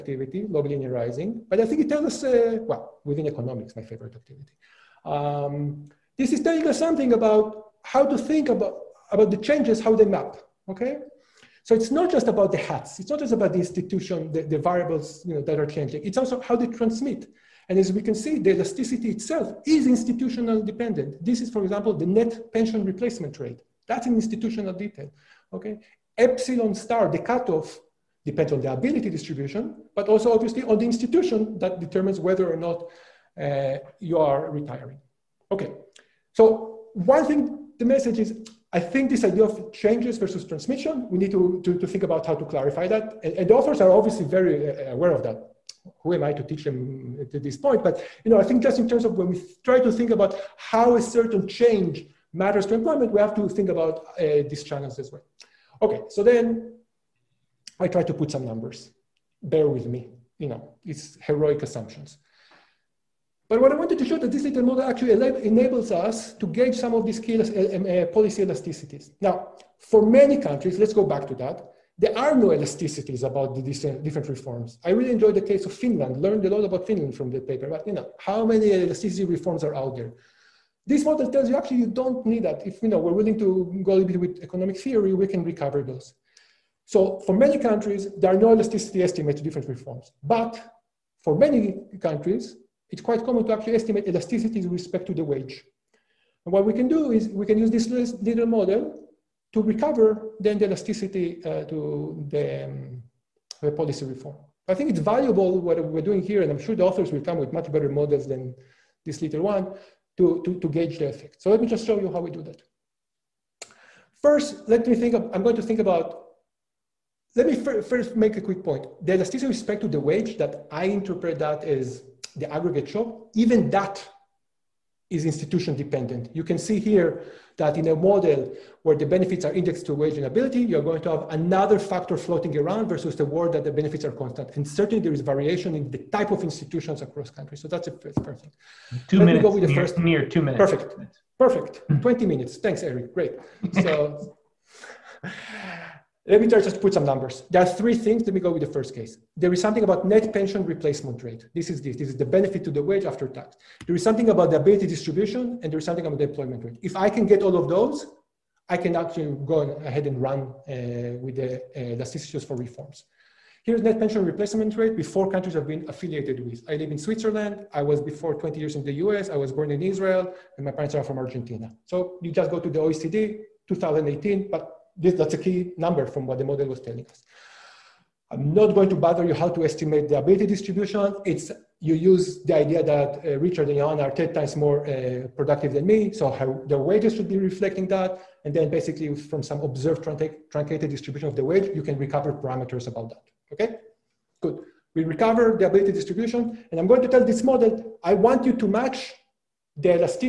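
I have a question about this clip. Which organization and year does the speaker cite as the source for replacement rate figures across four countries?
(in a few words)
OECD, 2018.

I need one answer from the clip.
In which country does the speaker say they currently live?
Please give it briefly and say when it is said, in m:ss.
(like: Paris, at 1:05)
Switzerland, at 2:46.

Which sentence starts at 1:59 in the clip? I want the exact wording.
The elasticity with respect to the wage that I interpret that as the aggregate shock, even that is institution dependent.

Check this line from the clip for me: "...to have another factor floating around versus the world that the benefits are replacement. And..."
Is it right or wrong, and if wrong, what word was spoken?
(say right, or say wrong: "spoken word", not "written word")
wrong: "constant", not "replacement".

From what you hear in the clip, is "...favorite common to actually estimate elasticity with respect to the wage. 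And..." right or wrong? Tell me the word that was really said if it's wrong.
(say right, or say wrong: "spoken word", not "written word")
wrong: "quite", not "favorite".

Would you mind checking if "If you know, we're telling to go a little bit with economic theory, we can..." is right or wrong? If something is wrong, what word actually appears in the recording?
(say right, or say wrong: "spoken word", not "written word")
wrong: "willing", not "telling".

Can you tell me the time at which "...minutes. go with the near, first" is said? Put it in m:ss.
2:19.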